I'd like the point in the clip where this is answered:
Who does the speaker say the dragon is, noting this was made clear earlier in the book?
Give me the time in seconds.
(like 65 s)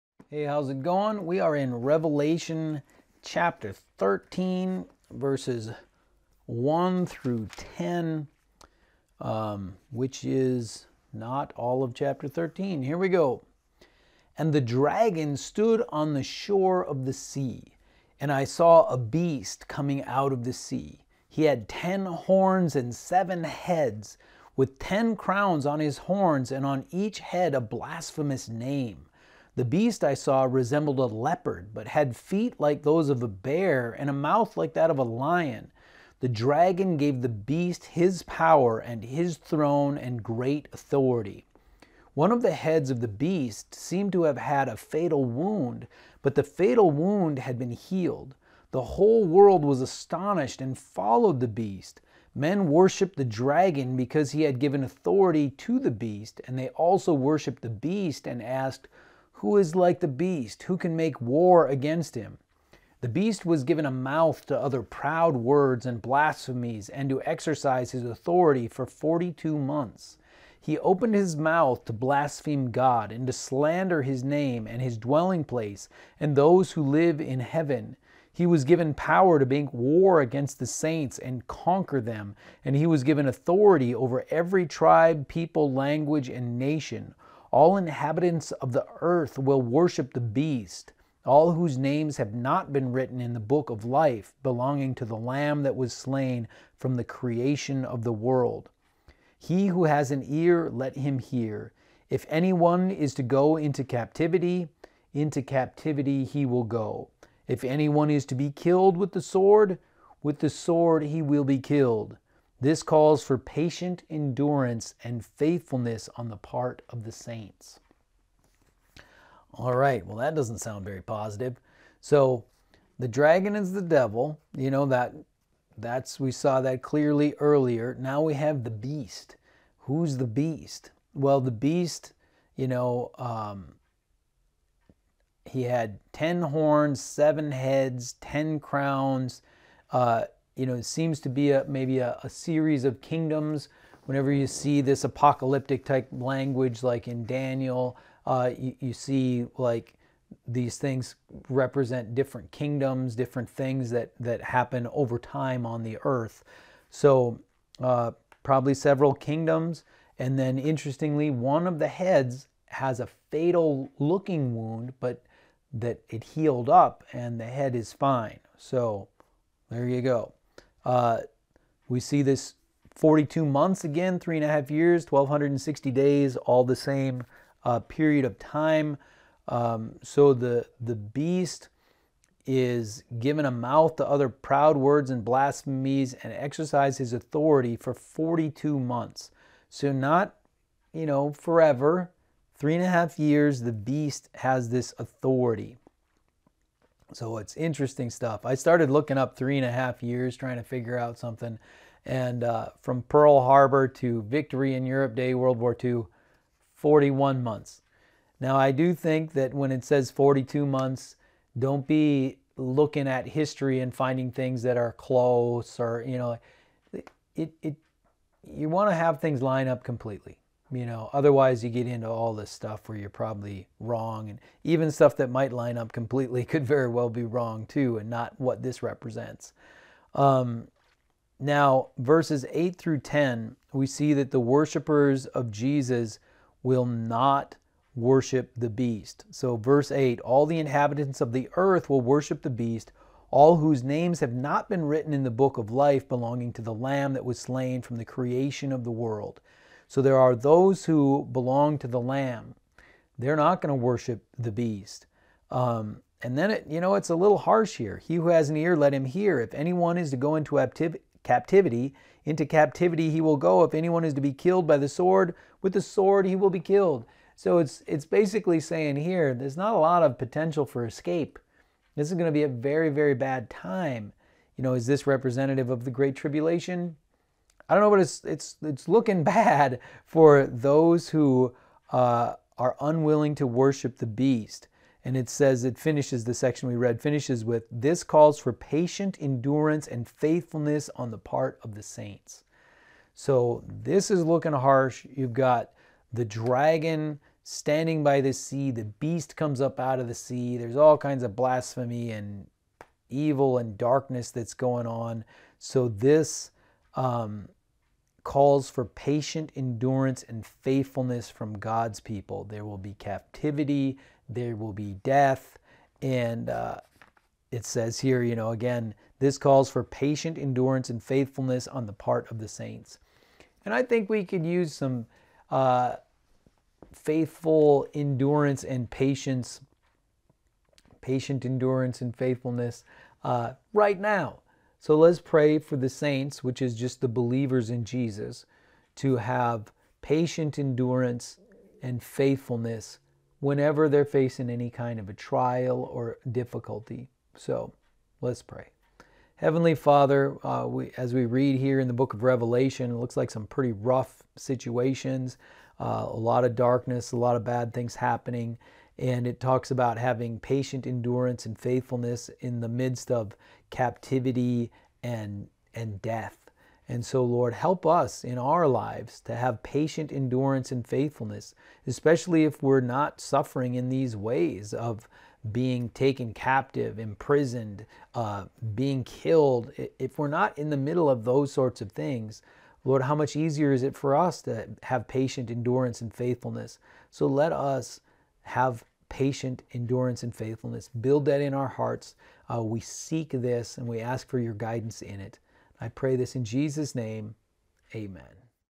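123 s.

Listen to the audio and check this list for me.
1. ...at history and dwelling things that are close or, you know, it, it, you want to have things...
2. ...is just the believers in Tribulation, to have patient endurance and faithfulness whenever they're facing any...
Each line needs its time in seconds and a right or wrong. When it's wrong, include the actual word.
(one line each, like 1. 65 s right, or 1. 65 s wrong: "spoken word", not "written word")
1. 213 s wrong: "finding", not "dwelling"
2. 336 s wrong: "Jesus", not "Tribulation".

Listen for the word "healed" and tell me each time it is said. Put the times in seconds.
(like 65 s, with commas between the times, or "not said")
47 s, 166 s.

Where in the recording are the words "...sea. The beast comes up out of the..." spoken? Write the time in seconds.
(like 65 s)
298 s.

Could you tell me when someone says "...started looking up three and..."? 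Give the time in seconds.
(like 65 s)
198 s.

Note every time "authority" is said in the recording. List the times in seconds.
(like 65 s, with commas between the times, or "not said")
40 s, 54 s, 68 s, 83 s, 187 s, 194 s.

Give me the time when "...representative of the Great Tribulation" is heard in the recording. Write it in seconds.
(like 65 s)
275 s.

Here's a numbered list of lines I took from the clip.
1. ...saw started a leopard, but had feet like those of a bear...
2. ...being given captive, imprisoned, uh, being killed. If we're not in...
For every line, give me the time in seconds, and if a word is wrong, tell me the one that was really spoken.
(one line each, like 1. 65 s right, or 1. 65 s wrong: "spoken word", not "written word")
1. 30 s wrong: "resembled", not "started"
2. 375 s wrong: "taken", not "given".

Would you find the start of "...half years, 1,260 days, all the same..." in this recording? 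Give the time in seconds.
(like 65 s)
174 s.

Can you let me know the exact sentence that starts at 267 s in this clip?
So it's, it's basically saying here, there's not a lot of potential for escape.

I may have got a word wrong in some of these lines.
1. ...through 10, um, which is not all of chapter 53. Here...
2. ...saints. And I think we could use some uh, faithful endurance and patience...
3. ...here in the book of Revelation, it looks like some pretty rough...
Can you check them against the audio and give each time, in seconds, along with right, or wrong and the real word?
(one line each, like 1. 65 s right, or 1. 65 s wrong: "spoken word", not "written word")
1. 7 s wrong: "13", not "53"
2. 322 s right
3. 351 s right.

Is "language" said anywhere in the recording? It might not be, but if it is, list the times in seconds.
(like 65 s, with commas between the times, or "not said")
85 s, 146 s.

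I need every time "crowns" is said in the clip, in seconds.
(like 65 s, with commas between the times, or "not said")
25 s, 138 s.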